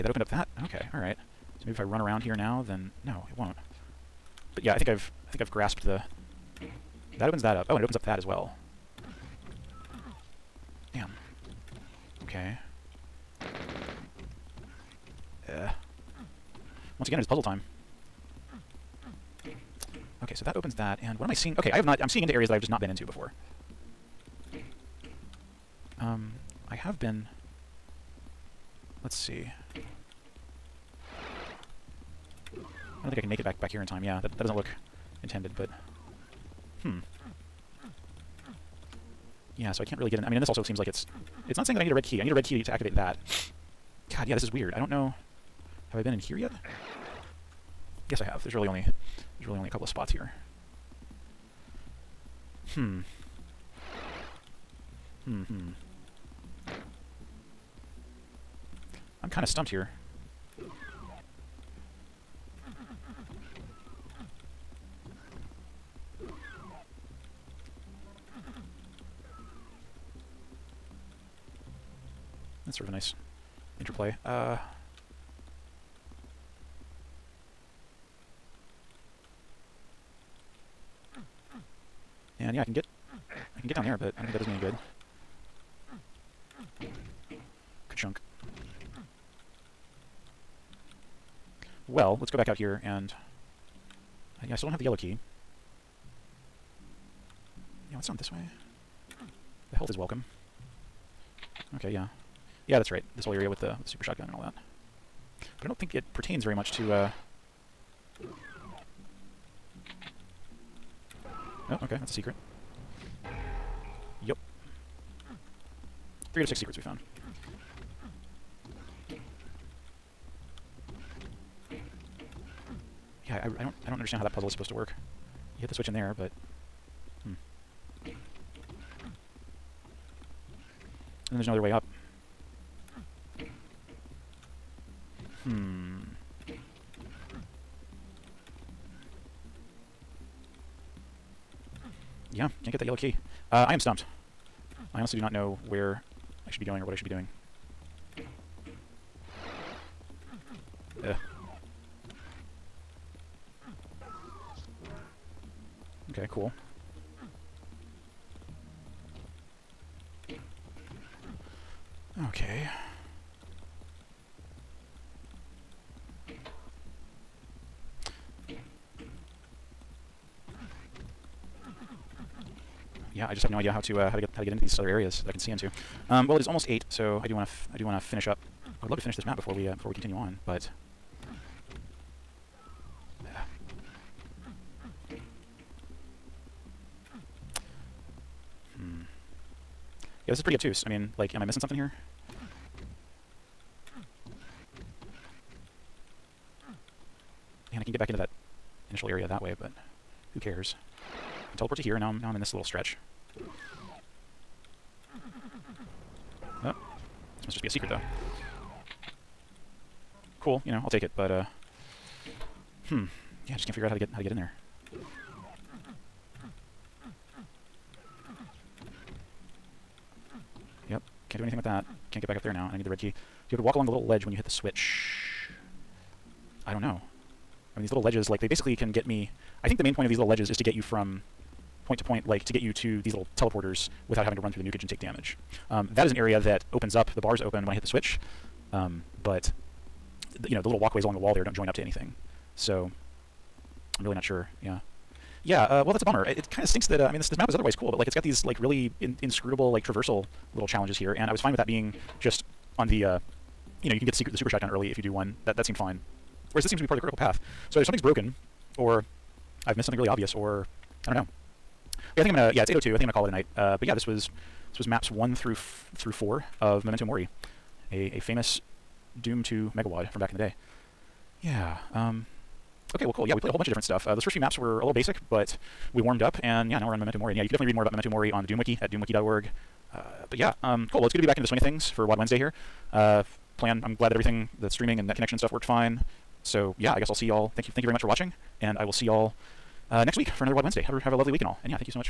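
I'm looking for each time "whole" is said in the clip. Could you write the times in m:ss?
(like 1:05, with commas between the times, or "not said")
1:43, 4:33.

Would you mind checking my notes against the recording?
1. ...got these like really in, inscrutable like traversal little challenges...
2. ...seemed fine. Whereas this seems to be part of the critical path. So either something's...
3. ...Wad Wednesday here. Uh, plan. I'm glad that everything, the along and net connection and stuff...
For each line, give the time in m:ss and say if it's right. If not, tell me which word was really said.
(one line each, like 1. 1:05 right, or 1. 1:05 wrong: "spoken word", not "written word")
1. 4:08 right
2. 4:15 right
3. 4:42 wrong: "streaming", not "along".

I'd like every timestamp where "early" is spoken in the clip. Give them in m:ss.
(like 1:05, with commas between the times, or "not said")
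4:14.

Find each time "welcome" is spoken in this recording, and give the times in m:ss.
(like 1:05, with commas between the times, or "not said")
1:39.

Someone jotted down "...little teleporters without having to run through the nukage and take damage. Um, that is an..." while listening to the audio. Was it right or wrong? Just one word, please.
right.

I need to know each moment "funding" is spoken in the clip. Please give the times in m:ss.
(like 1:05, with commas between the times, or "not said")
not said.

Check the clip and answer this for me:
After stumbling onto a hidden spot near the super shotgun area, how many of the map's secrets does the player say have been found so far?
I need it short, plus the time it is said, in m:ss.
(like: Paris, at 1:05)
3 out of 6, at 1:56.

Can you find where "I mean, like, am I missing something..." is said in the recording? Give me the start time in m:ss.
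3:10.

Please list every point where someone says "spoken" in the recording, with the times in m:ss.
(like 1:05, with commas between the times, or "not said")
not said.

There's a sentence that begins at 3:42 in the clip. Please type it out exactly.
Can't get back up there now, and I need the red key.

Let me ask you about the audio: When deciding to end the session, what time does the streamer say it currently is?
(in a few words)
8:02.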